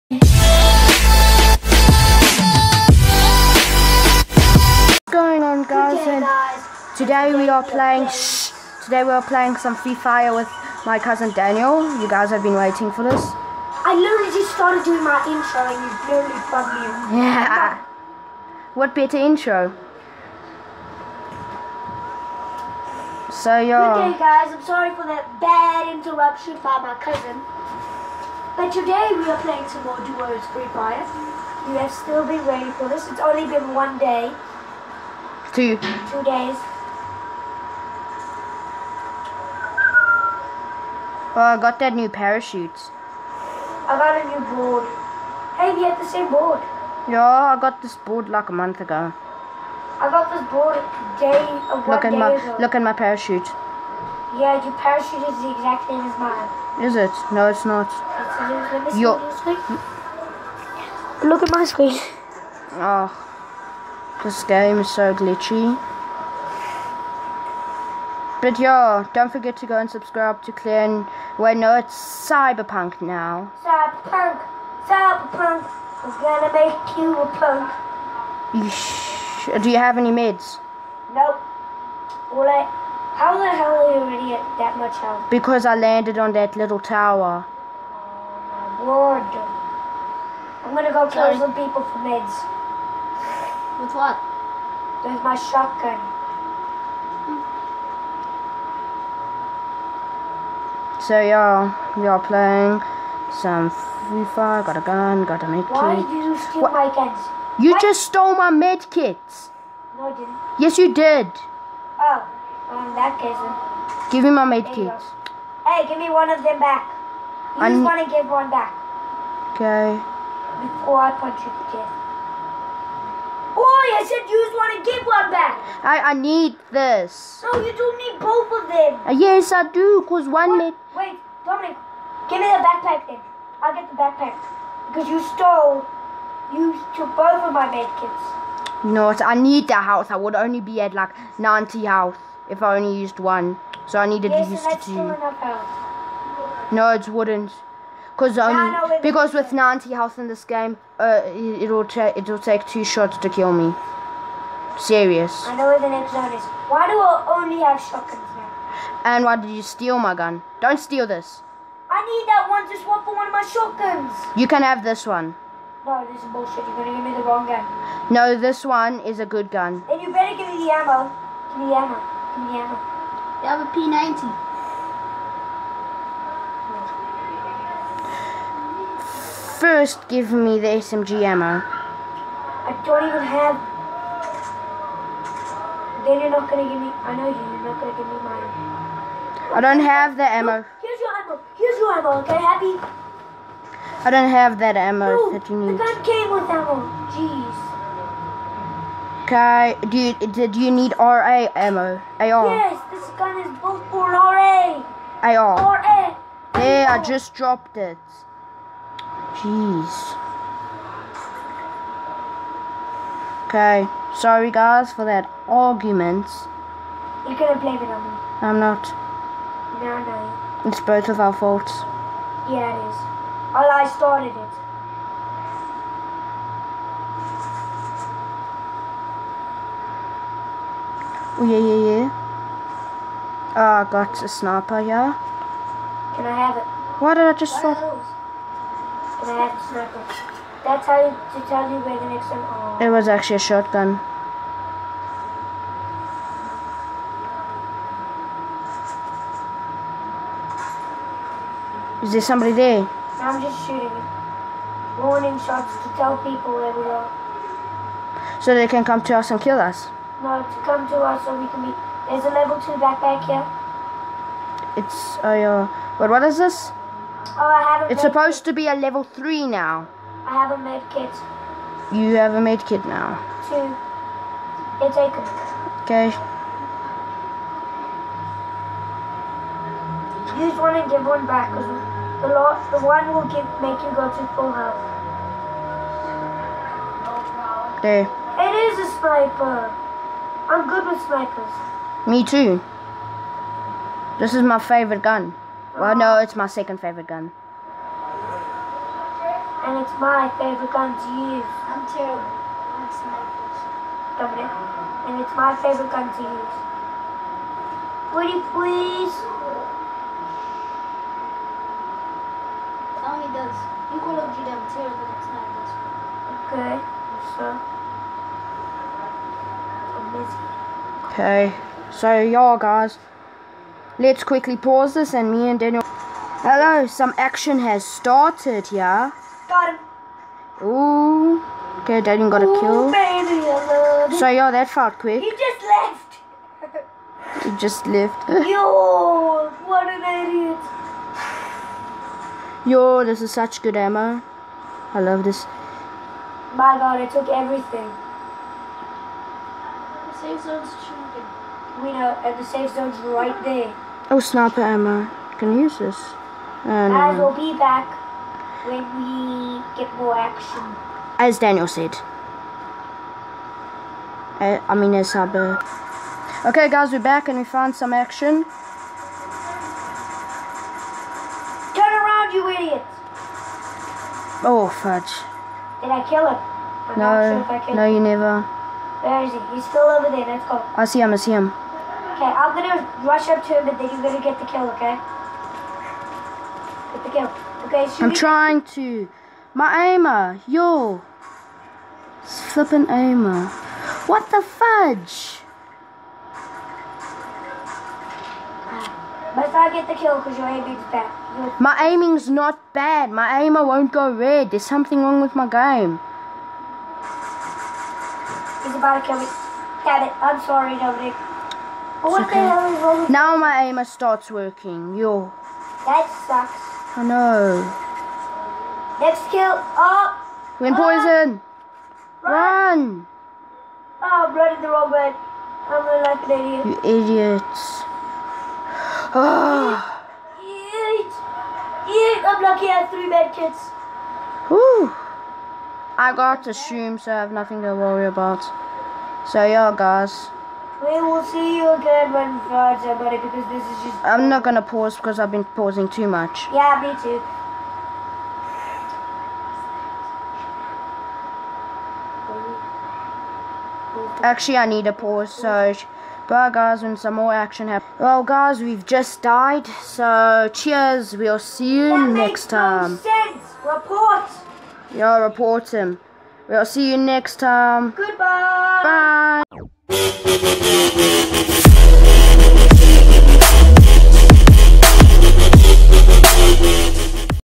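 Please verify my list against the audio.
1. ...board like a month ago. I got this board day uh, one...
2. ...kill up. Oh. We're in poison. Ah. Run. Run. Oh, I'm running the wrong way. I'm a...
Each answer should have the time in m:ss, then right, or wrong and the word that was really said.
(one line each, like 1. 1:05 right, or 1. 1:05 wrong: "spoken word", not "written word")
1. 0:47 right
2. 6:59 right.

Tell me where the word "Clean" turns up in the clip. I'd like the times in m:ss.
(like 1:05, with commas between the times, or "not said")
1:10.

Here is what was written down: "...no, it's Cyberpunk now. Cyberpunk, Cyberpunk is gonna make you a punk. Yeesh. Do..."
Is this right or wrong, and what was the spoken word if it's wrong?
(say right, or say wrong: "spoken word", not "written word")
right.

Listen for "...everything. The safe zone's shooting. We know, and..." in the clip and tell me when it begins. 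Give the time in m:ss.
5:47.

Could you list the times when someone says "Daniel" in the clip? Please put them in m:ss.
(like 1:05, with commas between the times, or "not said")
0:11, 5:25, 5:32, 6:01.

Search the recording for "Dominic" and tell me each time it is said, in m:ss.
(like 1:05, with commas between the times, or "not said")
2:11, 6:50.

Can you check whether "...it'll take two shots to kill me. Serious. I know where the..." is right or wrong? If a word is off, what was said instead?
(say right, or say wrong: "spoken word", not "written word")
right.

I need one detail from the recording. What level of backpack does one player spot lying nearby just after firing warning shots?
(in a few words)
level 2.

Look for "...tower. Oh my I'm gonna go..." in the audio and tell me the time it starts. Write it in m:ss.
1:26.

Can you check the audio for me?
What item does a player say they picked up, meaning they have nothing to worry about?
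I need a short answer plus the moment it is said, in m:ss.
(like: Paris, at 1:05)
a shroom, at 7:16.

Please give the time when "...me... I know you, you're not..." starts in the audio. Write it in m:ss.
3:06.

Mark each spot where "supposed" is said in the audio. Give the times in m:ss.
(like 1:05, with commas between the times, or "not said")
4:28.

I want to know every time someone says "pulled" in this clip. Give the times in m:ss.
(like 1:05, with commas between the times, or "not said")
not said.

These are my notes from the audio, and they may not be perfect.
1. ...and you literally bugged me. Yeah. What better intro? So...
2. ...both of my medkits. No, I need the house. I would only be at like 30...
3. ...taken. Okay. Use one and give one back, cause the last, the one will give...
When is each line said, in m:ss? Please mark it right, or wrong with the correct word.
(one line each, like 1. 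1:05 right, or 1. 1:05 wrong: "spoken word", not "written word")
1. 0:15 right
2. 2:17 wrong: "90", not "30"
3. 4:34 right.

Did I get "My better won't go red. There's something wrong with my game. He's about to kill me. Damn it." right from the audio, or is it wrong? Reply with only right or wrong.
wrong.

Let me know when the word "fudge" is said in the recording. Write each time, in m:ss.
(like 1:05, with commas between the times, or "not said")
6:14, 6:34.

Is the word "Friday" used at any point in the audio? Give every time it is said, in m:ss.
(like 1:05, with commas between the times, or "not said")
7:22.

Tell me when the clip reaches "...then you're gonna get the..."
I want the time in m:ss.
6:23.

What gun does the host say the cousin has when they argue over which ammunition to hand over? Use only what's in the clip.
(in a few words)
P90.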